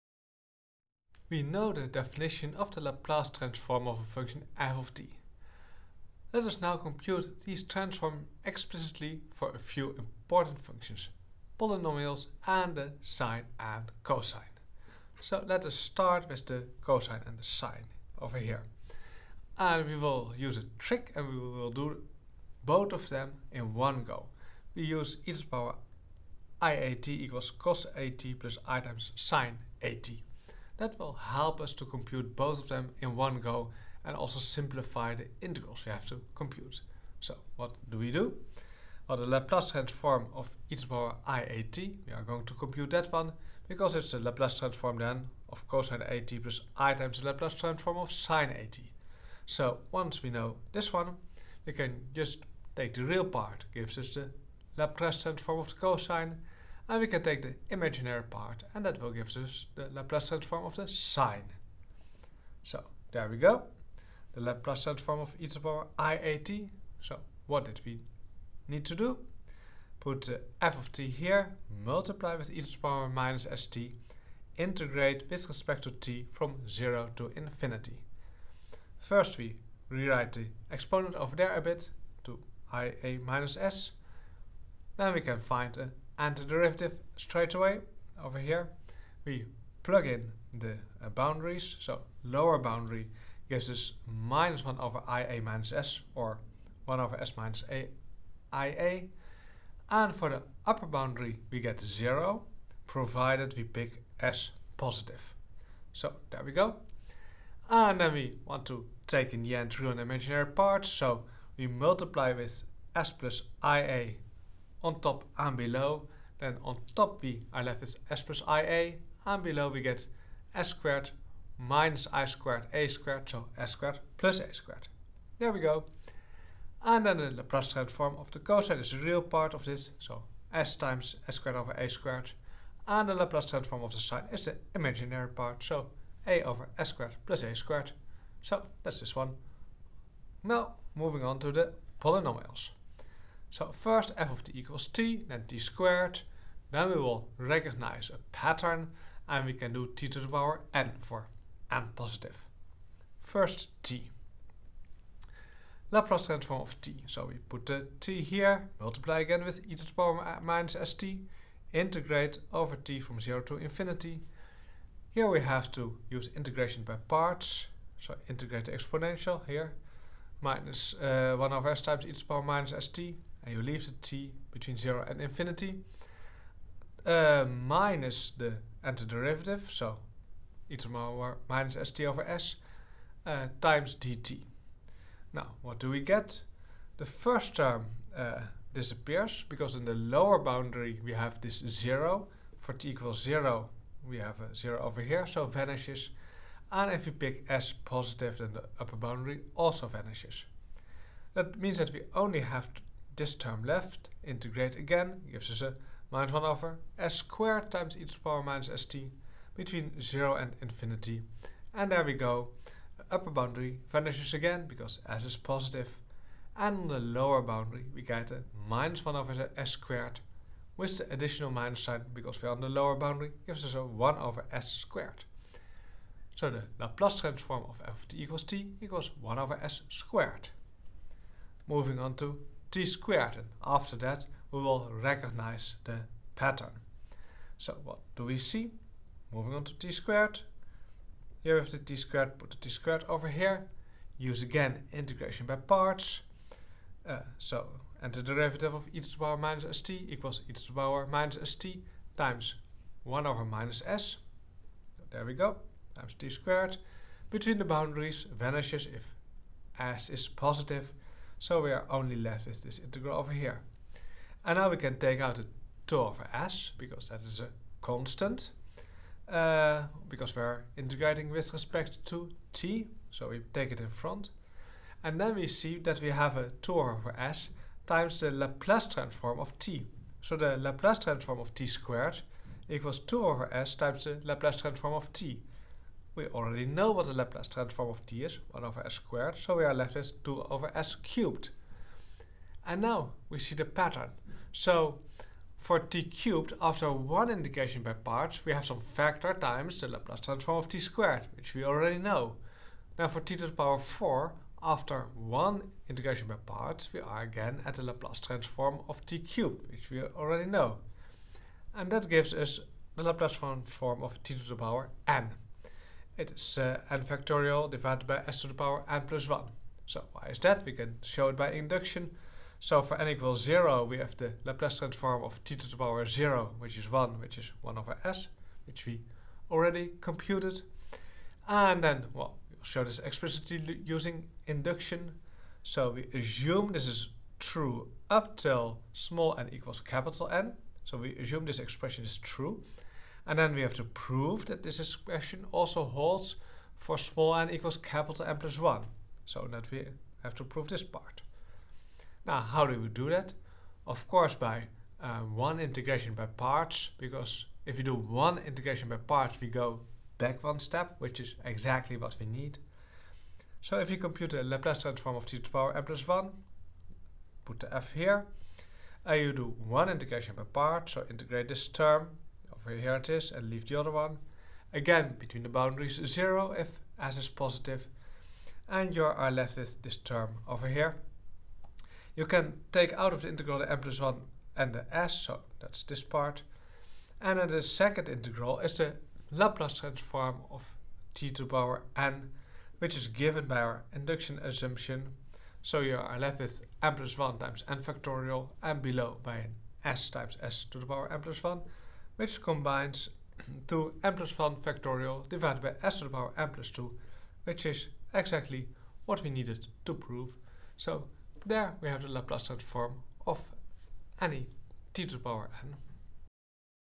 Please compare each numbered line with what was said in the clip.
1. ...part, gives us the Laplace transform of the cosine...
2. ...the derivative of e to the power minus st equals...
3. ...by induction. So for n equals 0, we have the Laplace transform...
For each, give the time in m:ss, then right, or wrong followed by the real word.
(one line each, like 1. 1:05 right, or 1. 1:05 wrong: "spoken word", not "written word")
1. 0:53 right
2. 4:08 right
3. 5:21 right.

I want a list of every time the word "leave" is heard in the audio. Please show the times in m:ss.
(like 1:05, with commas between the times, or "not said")
2:53, 6:13.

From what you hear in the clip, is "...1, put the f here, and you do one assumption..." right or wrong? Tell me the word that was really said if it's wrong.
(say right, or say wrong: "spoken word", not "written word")
wrong: "integration", not "assumption".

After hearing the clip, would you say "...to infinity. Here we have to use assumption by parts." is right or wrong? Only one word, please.
wrong.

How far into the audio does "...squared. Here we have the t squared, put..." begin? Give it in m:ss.
3:59.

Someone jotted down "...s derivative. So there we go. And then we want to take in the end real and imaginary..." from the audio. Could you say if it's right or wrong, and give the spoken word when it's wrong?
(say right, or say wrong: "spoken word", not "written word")
wrong: "positive", not "derivative".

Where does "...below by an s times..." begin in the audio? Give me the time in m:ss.
6:38.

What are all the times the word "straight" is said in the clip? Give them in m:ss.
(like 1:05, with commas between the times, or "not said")
1:27.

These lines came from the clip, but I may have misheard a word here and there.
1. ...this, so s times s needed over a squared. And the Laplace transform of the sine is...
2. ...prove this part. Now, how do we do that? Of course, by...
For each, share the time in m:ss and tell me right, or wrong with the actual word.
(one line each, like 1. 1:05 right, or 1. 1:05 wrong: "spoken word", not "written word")
1. 2:09 wrong: "squared", not "needed"
2. 5:50 right.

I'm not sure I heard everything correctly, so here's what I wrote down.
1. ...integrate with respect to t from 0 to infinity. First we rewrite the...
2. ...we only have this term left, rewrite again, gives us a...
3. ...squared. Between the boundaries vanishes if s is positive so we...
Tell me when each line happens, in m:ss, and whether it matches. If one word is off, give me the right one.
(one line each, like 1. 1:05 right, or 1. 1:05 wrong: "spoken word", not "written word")
1. 1:14 right
2. 3:21 wrong: "integrate", not "rewrite"
3. 4:16 right.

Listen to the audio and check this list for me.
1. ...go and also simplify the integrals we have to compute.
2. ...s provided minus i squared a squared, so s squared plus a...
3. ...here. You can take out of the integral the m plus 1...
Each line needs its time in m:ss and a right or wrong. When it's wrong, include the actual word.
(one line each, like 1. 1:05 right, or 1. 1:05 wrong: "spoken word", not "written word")
1. 0:33 right
2. 2:00 wrong: "squared", not "provided"
3. 6:20 right.